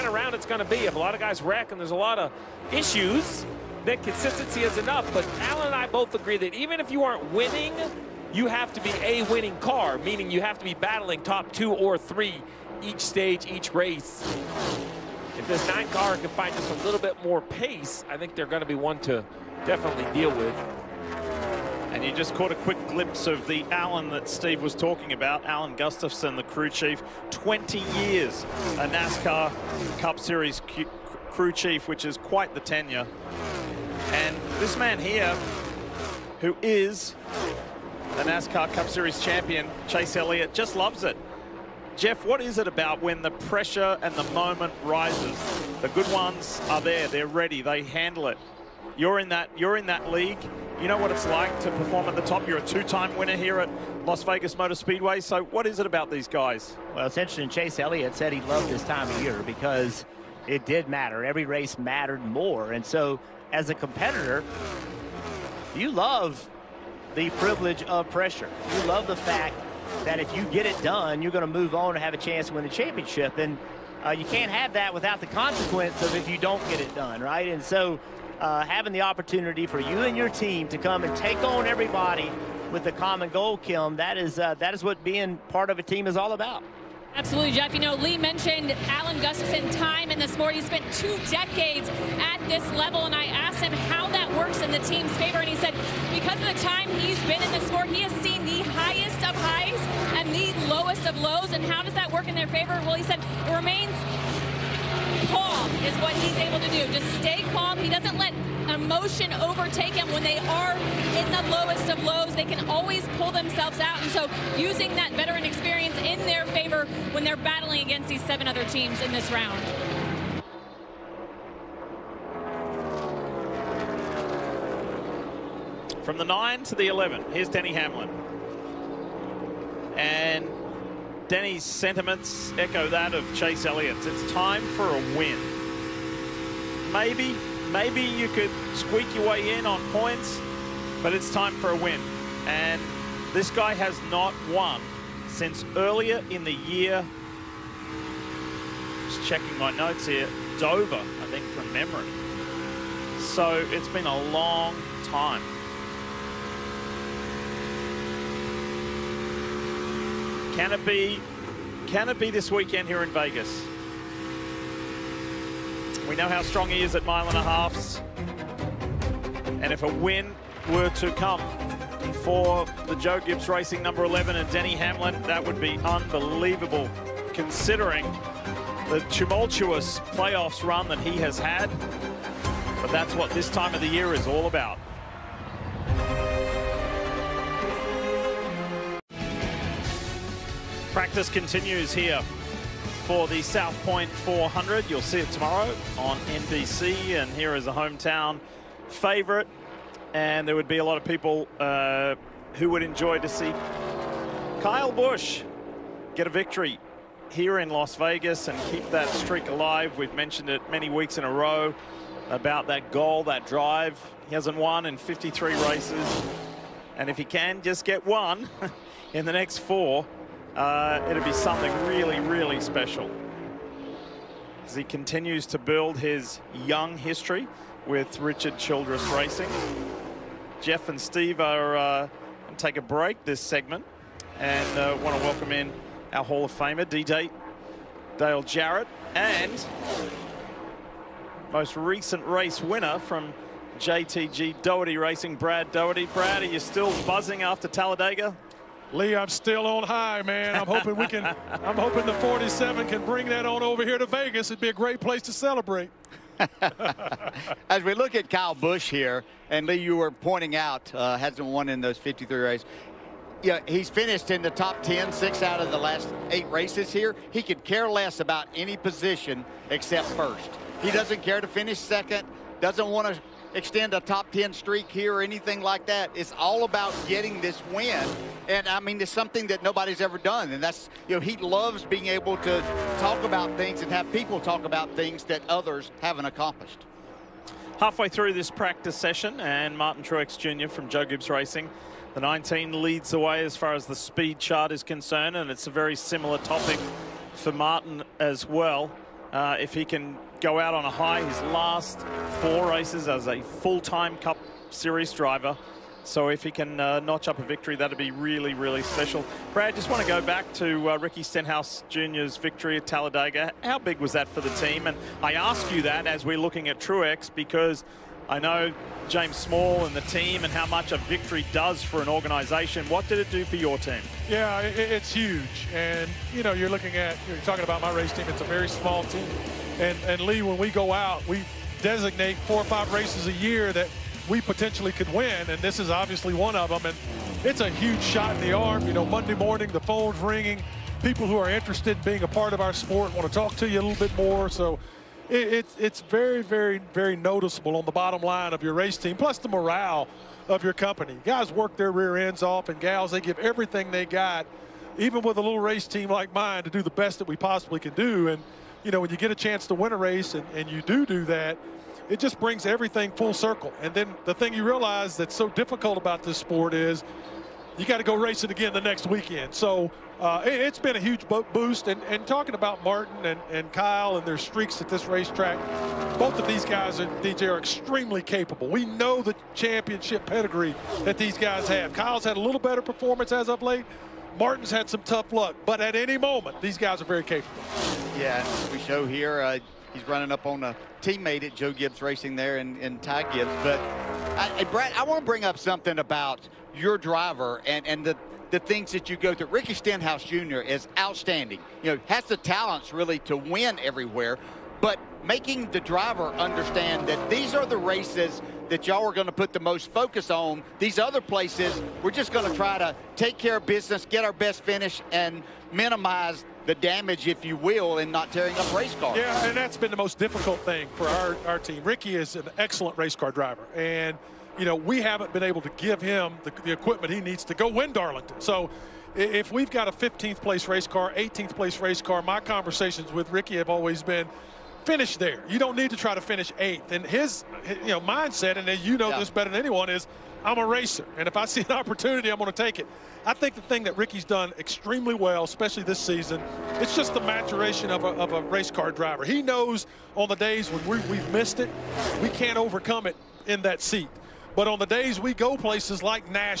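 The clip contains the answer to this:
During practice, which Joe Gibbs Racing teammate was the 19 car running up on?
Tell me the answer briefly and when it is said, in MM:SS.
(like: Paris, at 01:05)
Ty Gibbs, at 06:33.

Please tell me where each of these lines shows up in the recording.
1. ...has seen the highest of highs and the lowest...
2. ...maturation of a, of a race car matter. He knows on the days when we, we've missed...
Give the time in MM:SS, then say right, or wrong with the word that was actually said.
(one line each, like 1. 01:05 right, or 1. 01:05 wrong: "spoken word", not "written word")
1. 01:38 right
2. 07:27 wrong: "driver", not "matter".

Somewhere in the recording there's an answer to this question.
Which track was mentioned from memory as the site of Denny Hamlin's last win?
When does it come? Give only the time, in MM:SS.
02:30.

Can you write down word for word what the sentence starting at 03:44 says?
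As he continues to build his young history with Richard Childress Racing.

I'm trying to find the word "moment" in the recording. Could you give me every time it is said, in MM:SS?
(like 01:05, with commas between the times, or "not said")
00:44, 06:26.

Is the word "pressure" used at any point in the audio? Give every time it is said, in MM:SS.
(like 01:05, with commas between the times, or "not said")
00:43, 01:08.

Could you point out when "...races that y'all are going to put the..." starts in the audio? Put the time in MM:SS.
06:47.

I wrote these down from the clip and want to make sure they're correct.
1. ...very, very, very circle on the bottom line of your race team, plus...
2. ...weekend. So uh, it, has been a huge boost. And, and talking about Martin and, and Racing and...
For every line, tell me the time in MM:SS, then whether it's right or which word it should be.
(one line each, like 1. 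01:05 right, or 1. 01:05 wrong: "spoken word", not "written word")
1. 05:46 wrong: "noticeable", not "circle"
2. 06:09 wrong: "Kyle", not "Racing".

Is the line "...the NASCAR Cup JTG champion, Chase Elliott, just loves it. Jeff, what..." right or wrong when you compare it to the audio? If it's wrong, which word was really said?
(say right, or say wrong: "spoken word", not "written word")
wrong: "Series", not "JTG".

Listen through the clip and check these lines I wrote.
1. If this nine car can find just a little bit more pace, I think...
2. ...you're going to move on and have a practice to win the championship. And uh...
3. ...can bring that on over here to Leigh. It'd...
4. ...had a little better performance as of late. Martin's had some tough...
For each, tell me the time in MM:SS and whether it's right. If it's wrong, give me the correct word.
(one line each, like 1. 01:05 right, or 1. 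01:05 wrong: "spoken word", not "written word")
1. 00:15 right
2. 01:11 wrong: "chance", not "practice"
3. 04:12 wrong: "Vegas", not "Leigh"
4. 06:22 right.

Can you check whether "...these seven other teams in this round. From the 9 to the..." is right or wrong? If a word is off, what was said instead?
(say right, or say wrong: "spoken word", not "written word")
right.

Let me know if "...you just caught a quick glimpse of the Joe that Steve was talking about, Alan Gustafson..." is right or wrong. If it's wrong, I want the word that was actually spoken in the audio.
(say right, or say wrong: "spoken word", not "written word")
wrong: "Alan", not "Joe".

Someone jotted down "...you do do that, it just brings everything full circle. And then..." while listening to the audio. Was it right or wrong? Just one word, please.
right.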